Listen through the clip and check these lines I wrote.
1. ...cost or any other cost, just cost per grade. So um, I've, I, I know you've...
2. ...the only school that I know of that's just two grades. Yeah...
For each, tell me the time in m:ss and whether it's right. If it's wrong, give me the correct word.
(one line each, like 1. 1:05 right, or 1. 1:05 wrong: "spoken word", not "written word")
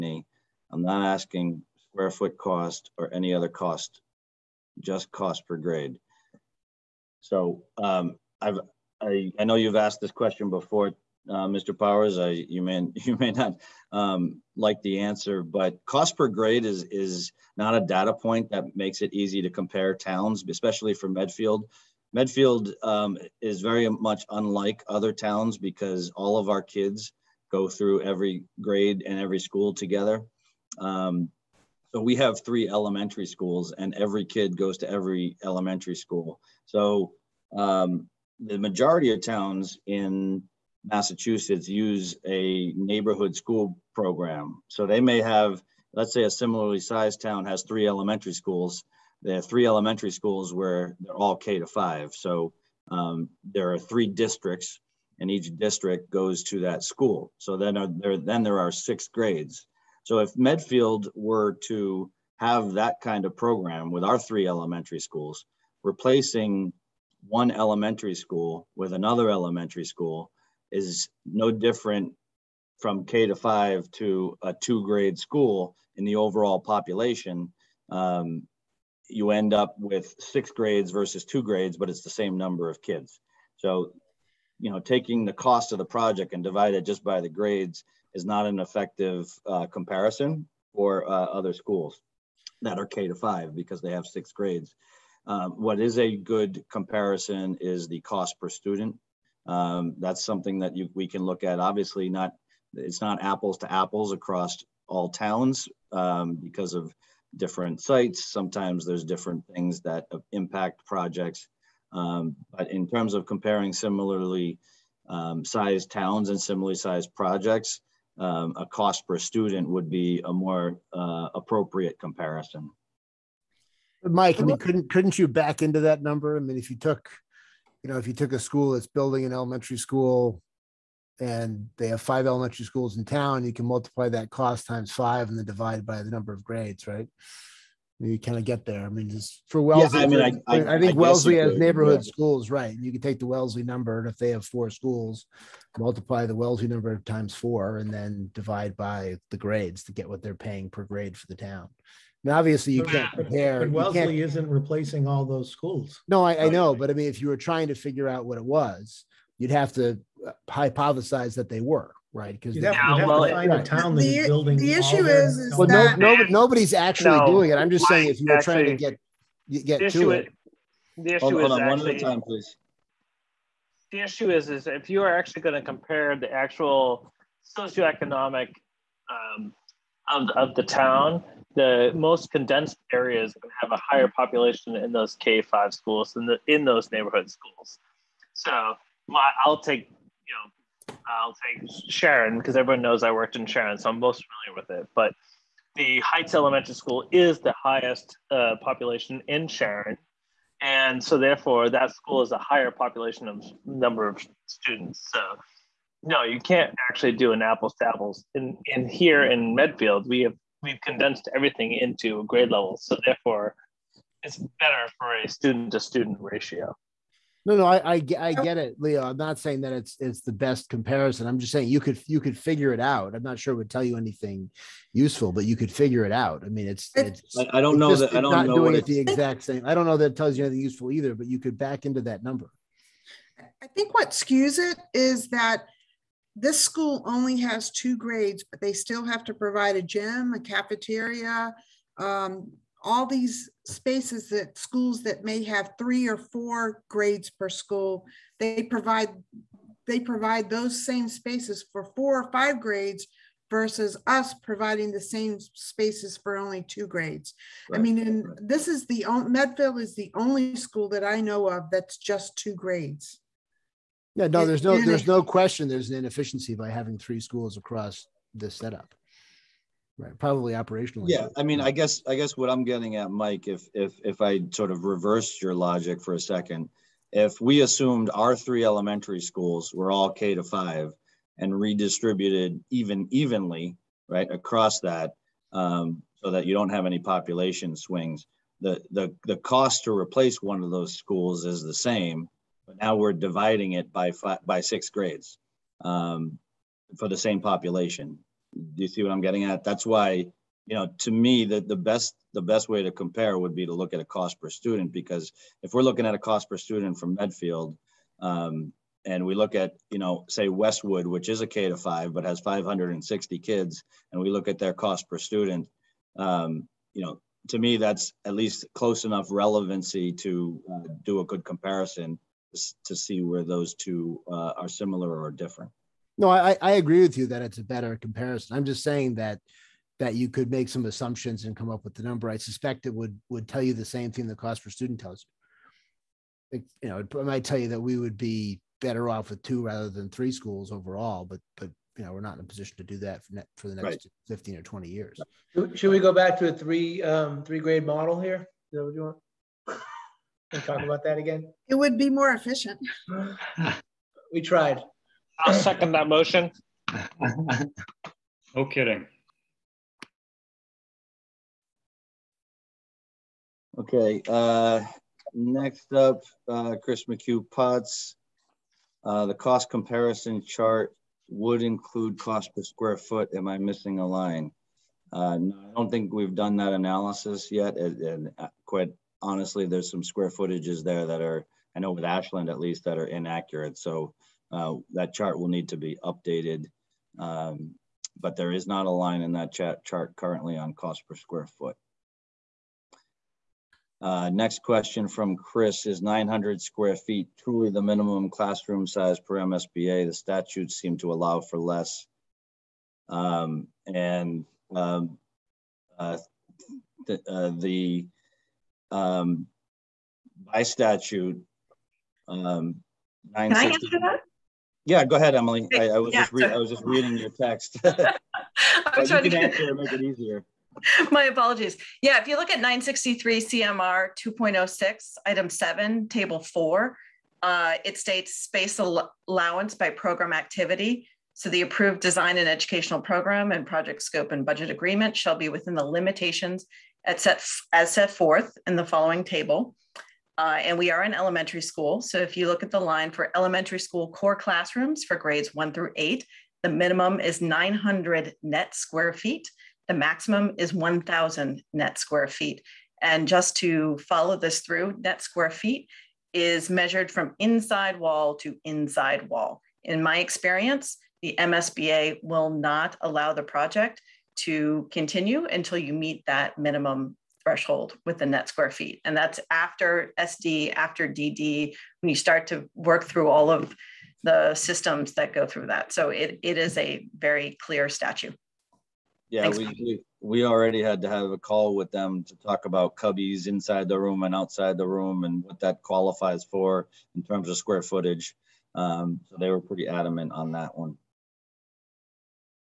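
1. 0:02 right
2. 4:19 right.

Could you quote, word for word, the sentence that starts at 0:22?
Medfield um, is very much unlike other towns because all of our kids go through every grade and every school together.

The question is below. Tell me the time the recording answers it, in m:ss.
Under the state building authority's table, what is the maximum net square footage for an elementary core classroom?
7:30.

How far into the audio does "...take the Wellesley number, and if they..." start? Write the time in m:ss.
2:23.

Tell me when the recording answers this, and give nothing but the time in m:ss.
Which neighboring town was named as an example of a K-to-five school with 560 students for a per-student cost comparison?
5:10.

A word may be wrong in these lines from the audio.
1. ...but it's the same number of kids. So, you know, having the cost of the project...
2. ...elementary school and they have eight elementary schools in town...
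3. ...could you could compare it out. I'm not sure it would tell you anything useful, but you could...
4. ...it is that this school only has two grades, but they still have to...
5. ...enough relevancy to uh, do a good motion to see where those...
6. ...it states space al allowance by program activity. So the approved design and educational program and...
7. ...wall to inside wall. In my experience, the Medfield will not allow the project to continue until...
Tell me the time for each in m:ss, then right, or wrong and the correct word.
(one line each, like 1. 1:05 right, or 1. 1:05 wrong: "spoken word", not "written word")
1. 1:21 wrong: "taking", not "having"
2. 2:09 wrong: "five", not "eight"
3. 3:41 wrong: "figure", not "compare"
4. 3:54 right
5. 5:19 wrong: "comparison", not "motion"
6. 7:07 right
7. 7:37 wrong: "MSBA", not "Medfield".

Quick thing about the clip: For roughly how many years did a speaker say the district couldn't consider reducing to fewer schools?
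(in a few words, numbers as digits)
15 or 20.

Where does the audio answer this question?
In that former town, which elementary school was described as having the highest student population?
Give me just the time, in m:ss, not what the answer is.
3:15.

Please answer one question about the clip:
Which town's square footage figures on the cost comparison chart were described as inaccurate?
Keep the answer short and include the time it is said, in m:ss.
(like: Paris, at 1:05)
Ashland, at 6:22.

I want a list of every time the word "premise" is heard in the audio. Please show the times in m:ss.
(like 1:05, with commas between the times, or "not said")
not said.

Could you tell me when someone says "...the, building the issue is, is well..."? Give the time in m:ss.
2:43.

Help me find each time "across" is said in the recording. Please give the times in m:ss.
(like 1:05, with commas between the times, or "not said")
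1:44, 4:27, 4:44.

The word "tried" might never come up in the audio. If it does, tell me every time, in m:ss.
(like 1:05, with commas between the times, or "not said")
5:54.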